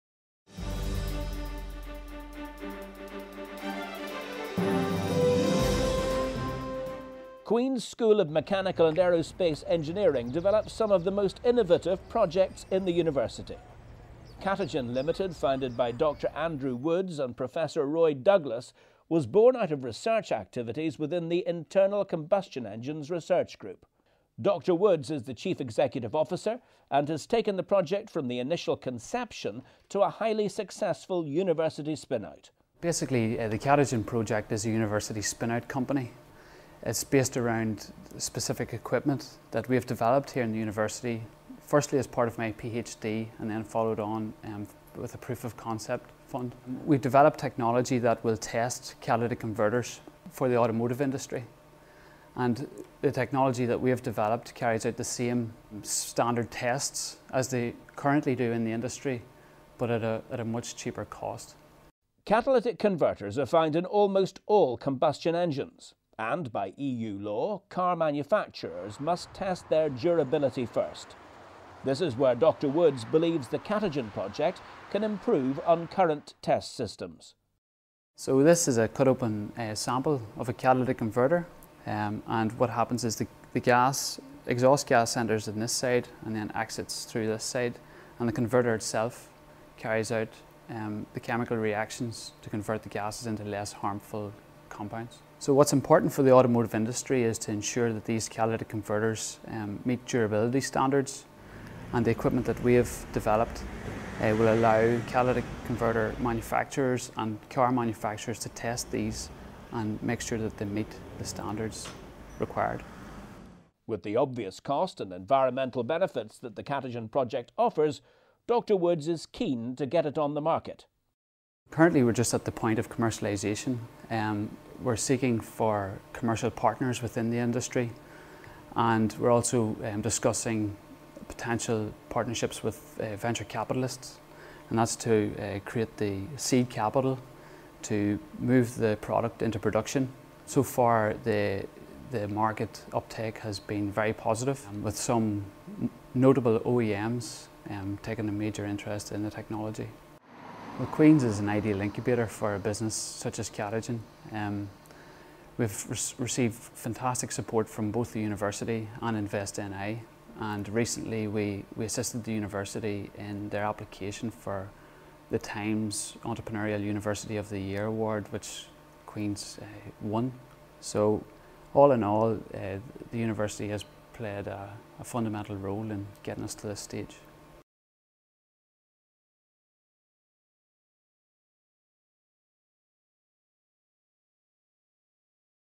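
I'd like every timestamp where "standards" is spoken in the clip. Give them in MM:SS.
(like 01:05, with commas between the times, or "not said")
00:55, 01:40, 01:51.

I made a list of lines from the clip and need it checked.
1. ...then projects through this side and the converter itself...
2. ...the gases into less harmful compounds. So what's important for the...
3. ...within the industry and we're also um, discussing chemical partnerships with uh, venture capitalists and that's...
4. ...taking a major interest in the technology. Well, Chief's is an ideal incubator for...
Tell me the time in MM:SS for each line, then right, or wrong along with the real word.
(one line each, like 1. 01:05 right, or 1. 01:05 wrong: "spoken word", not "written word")
1. 01:26 wrong: "exits", not "projects"
2. 01:32 right
3. 02:07 wrong: "potential", not "chemical"
4. 02:28 wrong: "Queen", not "Chief".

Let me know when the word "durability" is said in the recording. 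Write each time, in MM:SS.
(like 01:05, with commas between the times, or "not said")
01:09, 01:40.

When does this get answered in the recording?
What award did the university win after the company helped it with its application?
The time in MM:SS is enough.
02:45.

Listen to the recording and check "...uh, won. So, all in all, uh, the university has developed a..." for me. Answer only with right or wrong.
wrong.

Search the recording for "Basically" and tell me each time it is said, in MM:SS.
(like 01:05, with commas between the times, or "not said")
00:32.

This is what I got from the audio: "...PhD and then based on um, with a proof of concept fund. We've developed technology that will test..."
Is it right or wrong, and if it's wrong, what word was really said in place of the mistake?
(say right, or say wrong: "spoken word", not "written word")
wrong: "followed", not "based".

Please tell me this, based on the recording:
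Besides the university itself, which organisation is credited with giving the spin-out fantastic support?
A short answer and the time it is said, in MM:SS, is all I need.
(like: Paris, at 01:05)
Invest NI, at 02:39.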